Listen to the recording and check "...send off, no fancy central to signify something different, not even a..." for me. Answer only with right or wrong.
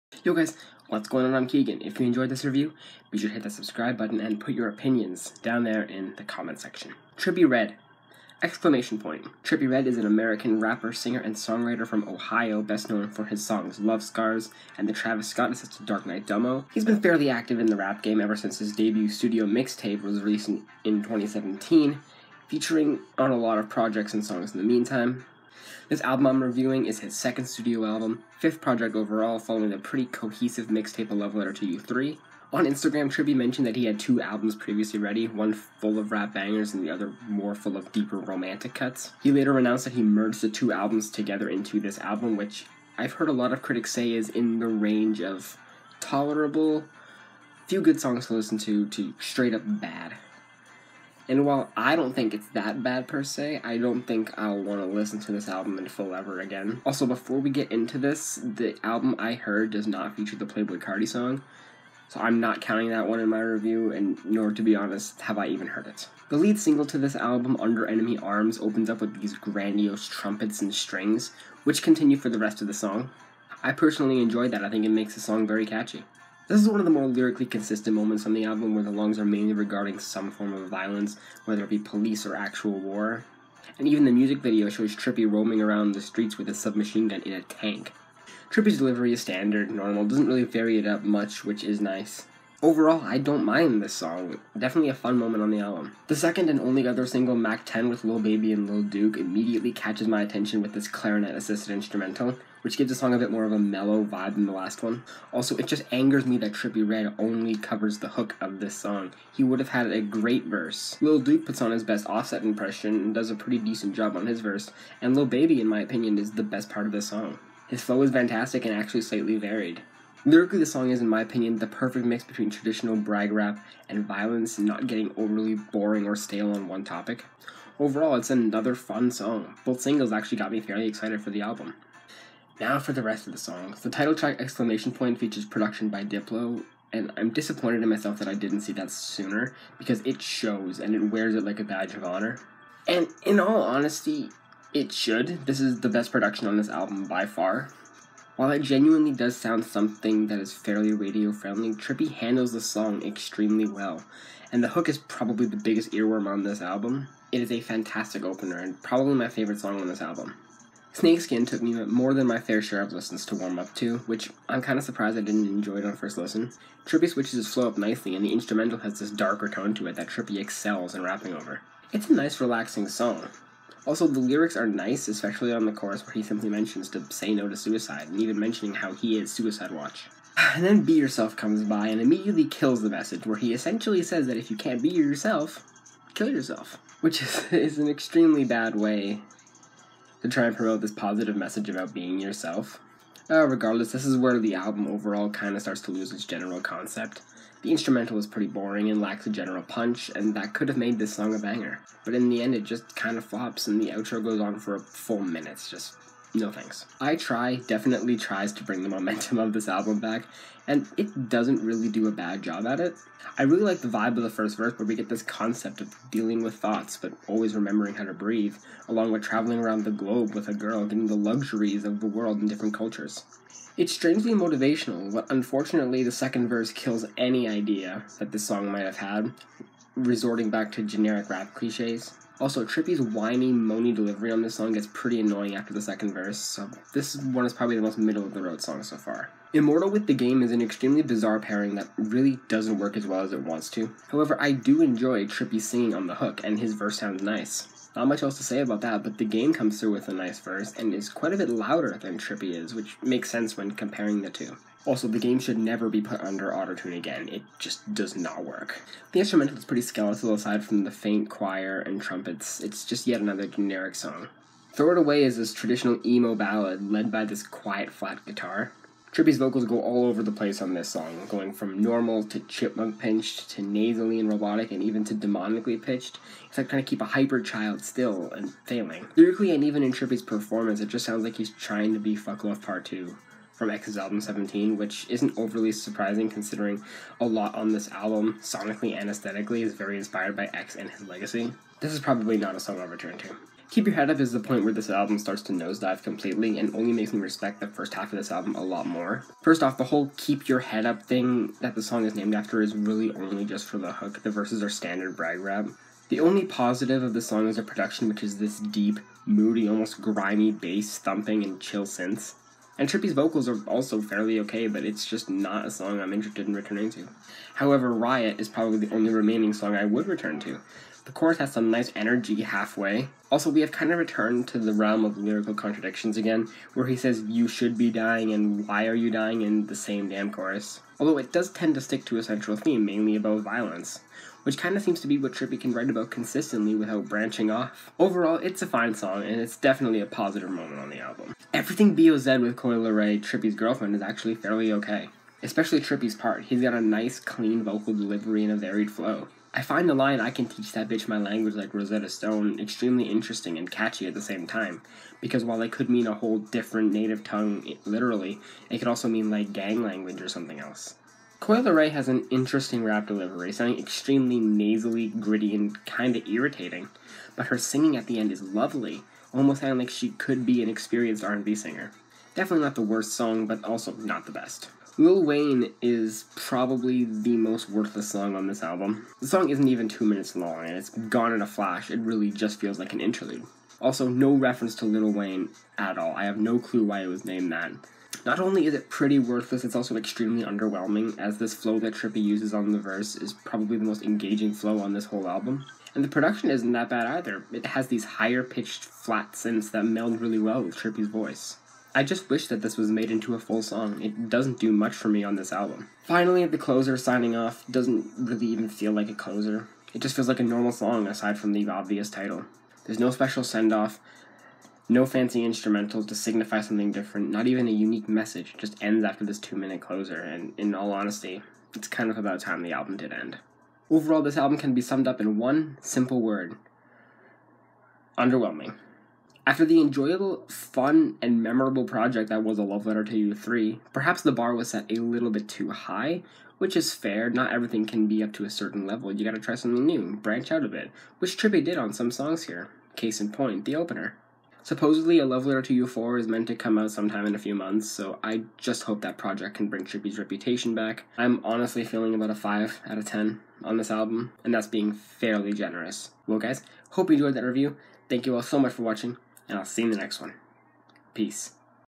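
wrong.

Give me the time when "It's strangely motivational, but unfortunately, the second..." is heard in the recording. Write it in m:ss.
3:43.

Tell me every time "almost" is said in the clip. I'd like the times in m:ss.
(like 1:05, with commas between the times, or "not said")
5:09, 6:09.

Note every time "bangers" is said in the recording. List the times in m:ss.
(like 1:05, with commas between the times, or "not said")
0:36, 3:21.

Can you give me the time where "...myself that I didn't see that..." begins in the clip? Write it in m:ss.
2:17.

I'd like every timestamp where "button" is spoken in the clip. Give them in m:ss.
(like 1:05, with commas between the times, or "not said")
0:03.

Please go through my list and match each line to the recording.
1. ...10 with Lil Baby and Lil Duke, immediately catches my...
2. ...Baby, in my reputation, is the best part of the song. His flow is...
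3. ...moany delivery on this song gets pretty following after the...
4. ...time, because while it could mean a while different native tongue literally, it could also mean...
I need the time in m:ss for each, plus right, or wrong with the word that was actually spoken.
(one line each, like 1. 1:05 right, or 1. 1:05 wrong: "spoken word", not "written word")
1. 1:37 right
2. 1:55 wrong: "opinion", not "reputation"
3. 3:53 wrong: "annoying", not "following"
4. 5:54 wrong: "whole", not "while".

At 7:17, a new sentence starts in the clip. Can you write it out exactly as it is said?
Not everything can be up to a certain level.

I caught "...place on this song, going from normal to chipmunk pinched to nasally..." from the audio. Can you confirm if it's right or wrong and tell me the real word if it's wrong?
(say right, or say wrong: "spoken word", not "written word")
right.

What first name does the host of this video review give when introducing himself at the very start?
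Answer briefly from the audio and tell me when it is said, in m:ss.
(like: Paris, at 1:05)
Keegan, at 0:01.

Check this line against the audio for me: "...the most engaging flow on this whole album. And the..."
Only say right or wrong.
right.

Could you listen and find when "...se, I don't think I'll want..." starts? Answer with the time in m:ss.
0:53.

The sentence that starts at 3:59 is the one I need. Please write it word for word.
Immortal with the Game is an extremely bizarre pairing that really doesn't work as well as it wants to.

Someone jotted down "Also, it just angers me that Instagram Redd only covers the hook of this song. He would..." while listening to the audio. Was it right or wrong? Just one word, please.
wrong.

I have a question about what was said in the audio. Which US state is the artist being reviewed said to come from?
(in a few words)
Ohio.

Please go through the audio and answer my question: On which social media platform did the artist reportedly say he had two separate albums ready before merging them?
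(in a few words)
Instagram.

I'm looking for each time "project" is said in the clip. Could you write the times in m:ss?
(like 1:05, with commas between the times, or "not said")
0:23, 0:28, 7:11, 7:29.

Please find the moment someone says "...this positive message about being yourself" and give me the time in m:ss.
3:10.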